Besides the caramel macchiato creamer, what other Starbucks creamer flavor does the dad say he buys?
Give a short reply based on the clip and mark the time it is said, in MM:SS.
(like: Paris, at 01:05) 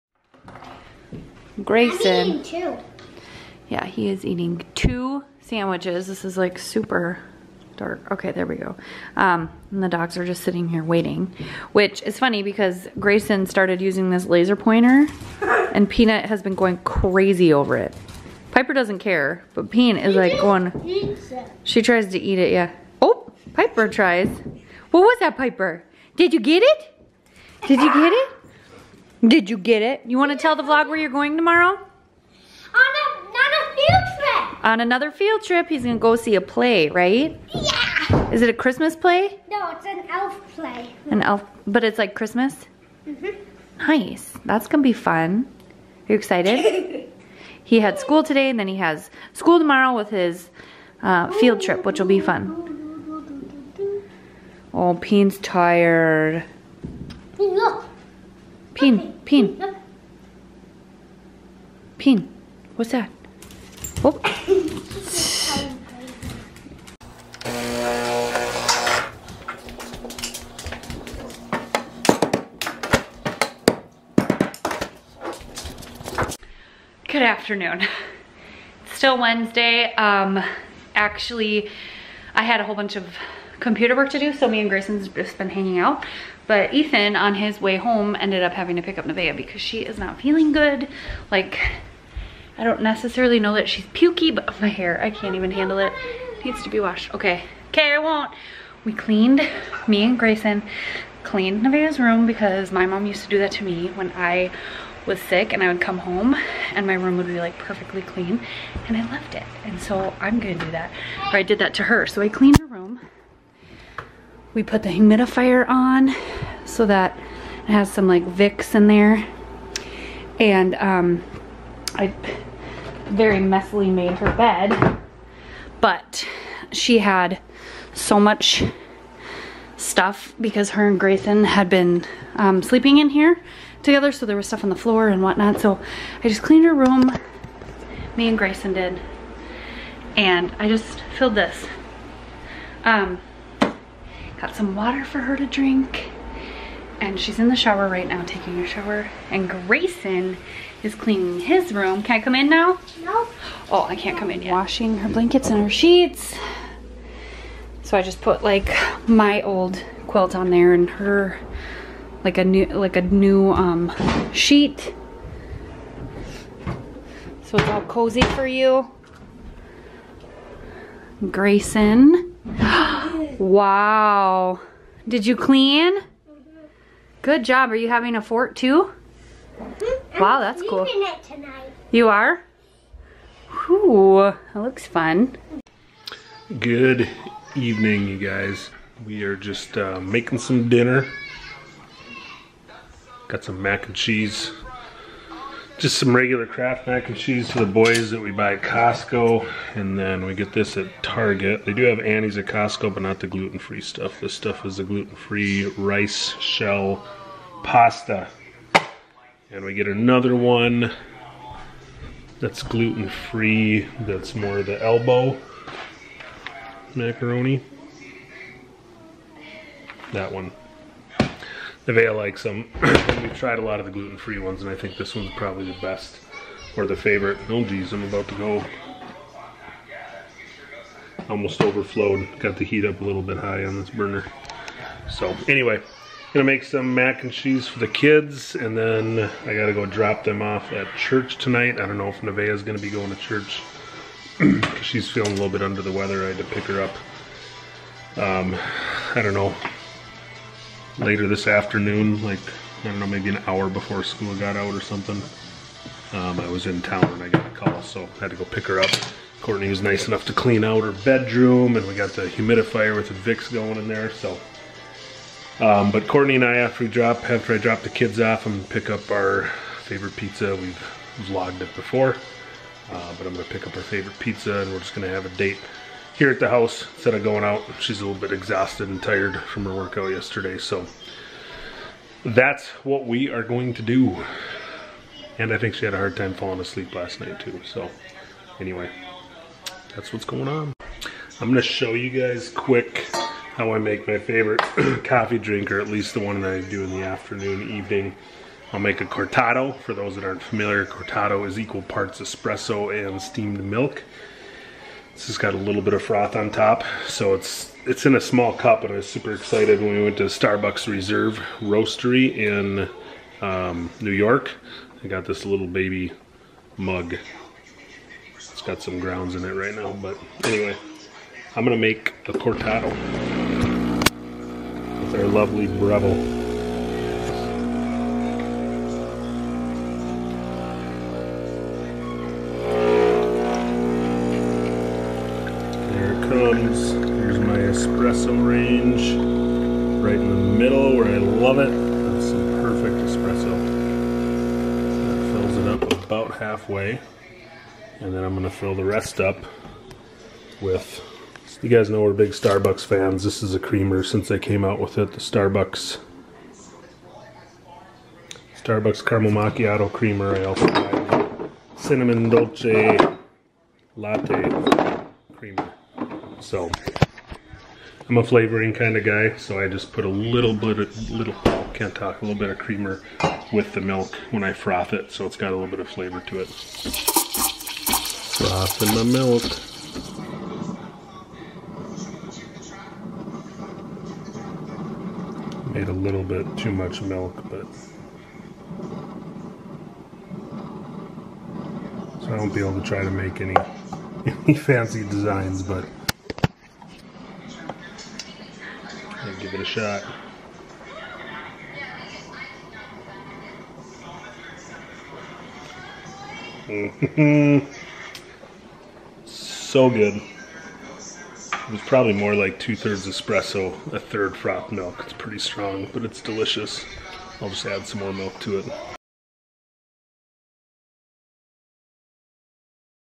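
Cinnamon dolce latte, at 06:01.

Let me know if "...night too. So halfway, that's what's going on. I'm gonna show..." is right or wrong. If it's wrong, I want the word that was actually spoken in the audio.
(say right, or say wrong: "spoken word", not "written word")
wrong: "anyway", not "halfway".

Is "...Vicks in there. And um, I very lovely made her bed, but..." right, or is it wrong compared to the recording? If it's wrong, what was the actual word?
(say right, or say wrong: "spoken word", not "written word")
wrong: "messily", not "lovely".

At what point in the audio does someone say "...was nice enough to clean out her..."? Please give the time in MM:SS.
04:19.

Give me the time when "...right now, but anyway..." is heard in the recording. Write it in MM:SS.
05:19.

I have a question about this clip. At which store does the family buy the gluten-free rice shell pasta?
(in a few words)
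Target.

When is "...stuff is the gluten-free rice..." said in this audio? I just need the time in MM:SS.
03:24.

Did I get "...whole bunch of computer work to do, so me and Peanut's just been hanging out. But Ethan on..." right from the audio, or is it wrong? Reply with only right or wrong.
wrong.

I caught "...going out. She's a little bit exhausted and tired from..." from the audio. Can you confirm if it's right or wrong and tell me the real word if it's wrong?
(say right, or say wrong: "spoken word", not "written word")
right.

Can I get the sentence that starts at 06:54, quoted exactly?
It's pretty strong, but it's delicious.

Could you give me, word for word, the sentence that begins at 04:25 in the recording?
Um, but Courtney and I, after we drop, after I drop the kids off, I'm gonna pick up our favorite pizza.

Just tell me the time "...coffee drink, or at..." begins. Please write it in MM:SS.
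04:55.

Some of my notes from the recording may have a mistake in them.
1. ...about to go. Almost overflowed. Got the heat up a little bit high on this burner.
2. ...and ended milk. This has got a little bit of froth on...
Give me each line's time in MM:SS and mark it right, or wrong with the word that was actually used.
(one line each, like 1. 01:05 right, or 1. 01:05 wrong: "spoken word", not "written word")
1. 03:48 right
2. 05:02 wrong: "steamed", not "ended".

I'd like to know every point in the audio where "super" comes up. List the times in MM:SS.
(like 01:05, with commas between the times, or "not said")
00:06, 05:09.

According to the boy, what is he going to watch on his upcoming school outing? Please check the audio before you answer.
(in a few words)
An elf play.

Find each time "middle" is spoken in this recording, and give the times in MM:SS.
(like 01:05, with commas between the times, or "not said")
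05:40.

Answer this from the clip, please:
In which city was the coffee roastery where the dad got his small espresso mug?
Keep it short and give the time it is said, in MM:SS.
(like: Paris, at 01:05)
New York, at 05:14.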